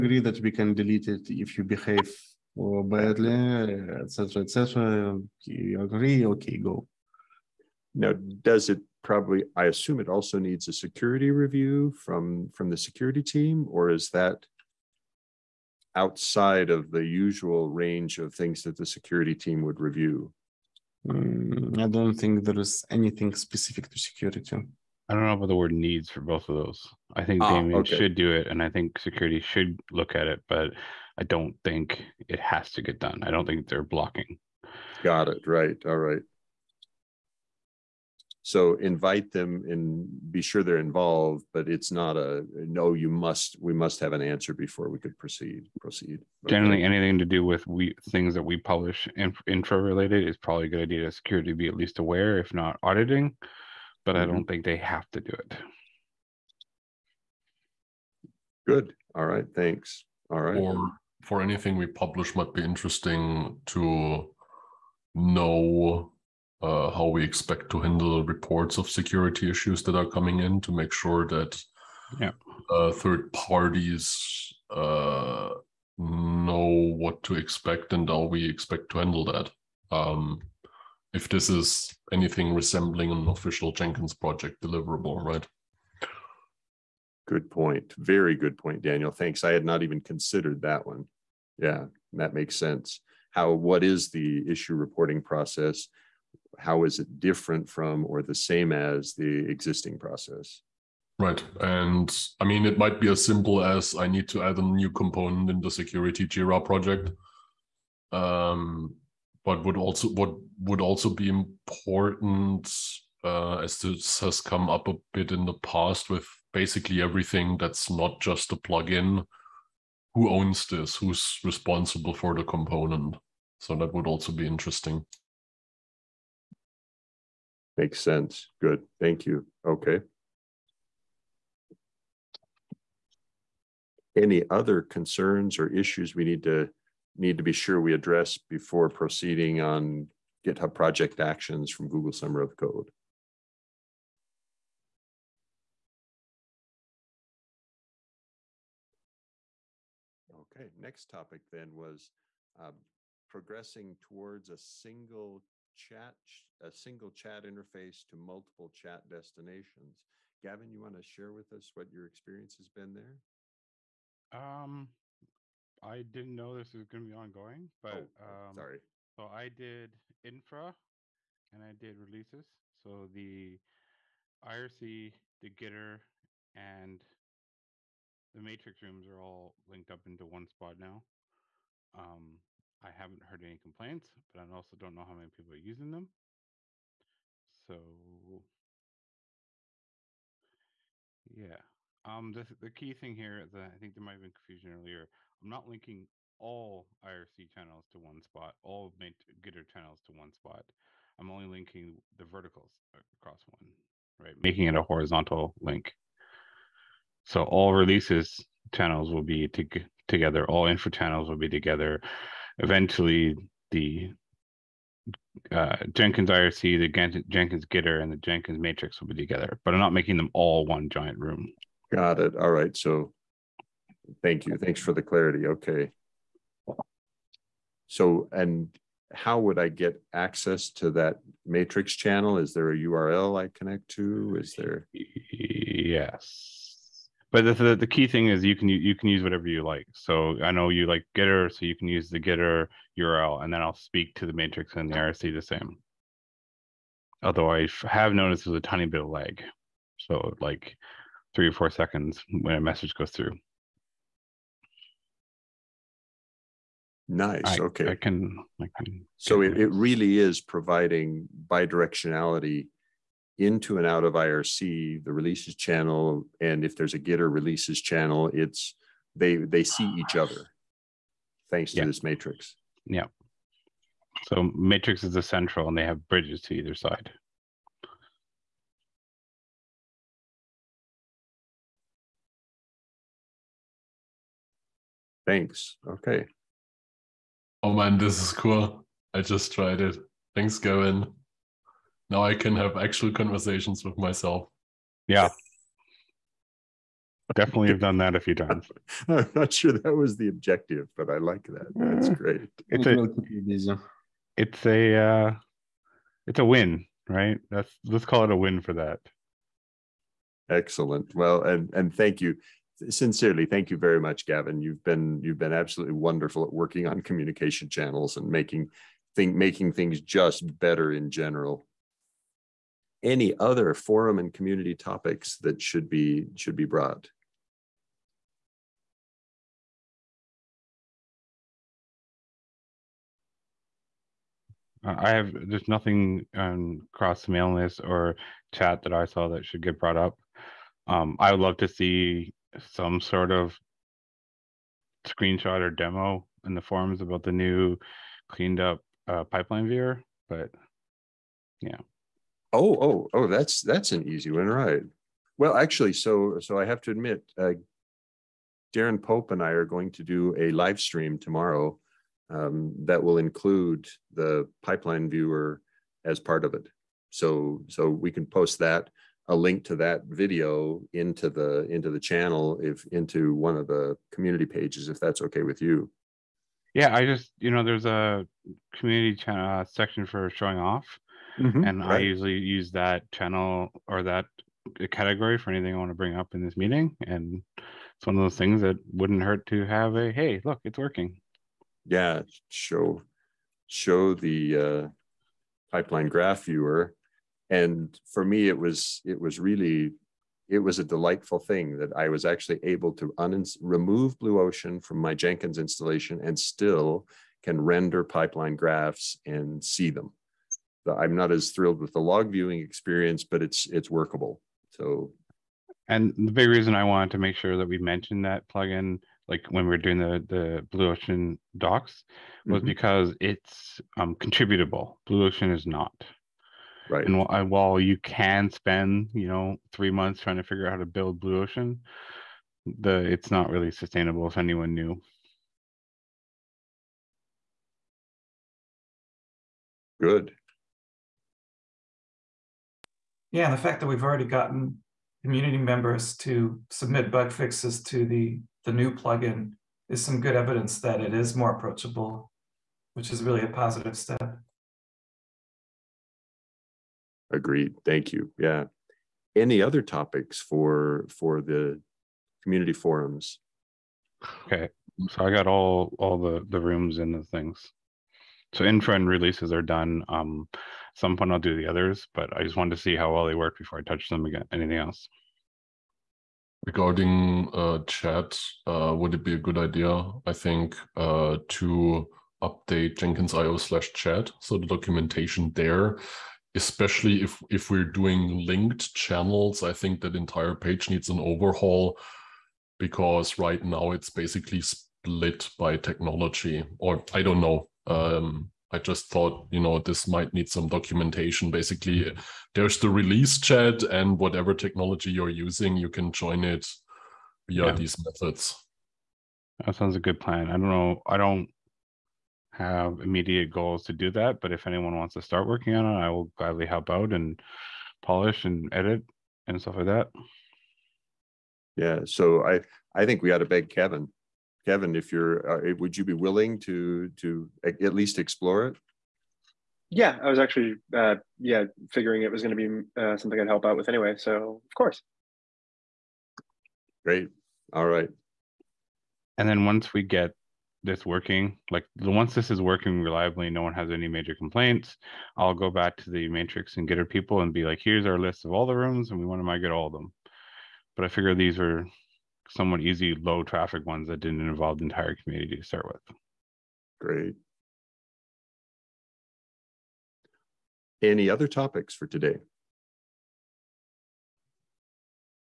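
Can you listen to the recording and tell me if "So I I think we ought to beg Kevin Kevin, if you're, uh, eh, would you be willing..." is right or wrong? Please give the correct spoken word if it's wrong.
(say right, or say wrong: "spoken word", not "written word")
right.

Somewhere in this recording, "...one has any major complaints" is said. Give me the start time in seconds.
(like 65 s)
543 s.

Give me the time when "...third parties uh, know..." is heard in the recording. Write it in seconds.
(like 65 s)
72 s.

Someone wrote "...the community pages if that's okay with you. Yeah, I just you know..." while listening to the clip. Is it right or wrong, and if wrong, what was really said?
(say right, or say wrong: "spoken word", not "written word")
right.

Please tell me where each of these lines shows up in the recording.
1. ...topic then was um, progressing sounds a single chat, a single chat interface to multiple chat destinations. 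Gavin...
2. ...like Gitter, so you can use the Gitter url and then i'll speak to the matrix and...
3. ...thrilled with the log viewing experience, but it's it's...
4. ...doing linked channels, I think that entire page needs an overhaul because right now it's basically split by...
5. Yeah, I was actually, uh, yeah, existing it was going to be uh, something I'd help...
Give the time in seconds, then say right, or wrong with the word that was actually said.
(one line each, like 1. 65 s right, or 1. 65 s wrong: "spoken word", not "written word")
1. 151 s wrong: "towards", not "sounds"
2. 240 s right
3. 411 s right
4. 487 s right
5. 529 s wrong: "figuring", not "existing".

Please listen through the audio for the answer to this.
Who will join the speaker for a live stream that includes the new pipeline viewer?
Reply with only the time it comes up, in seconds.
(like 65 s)
358 s.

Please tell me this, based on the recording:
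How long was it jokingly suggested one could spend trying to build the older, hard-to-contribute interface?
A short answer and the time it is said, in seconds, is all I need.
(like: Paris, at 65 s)
3 months, at 429 s.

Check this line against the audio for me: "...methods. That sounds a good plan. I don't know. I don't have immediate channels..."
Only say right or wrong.
wrong.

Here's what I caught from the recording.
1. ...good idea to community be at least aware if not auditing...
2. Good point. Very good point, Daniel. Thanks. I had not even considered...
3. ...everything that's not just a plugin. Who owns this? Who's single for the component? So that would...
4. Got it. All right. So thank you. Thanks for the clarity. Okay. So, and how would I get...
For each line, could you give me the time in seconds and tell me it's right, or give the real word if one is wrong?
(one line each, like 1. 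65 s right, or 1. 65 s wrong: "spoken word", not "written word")
1. 50 s wrong: "security", not "community"
2. 87 s right
3. 117 s wrong: "responsible", not "single"
4. 221 s right.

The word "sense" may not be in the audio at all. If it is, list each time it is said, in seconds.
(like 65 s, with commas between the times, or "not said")
92 s, 128 s.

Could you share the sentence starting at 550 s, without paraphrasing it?
But I figure these are somewhat easy, low traffic ones that didn't involve the entire community to start with.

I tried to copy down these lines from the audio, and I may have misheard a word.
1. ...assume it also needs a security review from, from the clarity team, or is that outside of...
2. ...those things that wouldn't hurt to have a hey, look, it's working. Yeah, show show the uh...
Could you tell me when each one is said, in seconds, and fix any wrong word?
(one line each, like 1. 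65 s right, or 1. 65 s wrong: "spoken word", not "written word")
1. 9 s wrong: "security", not "clarity"
2. 388 s right.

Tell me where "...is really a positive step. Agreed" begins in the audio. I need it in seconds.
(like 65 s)
453 s.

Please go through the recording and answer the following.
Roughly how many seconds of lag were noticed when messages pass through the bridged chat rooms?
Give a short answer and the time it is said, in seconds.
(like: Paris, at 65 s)
3 or 4 seconds, at 251 s.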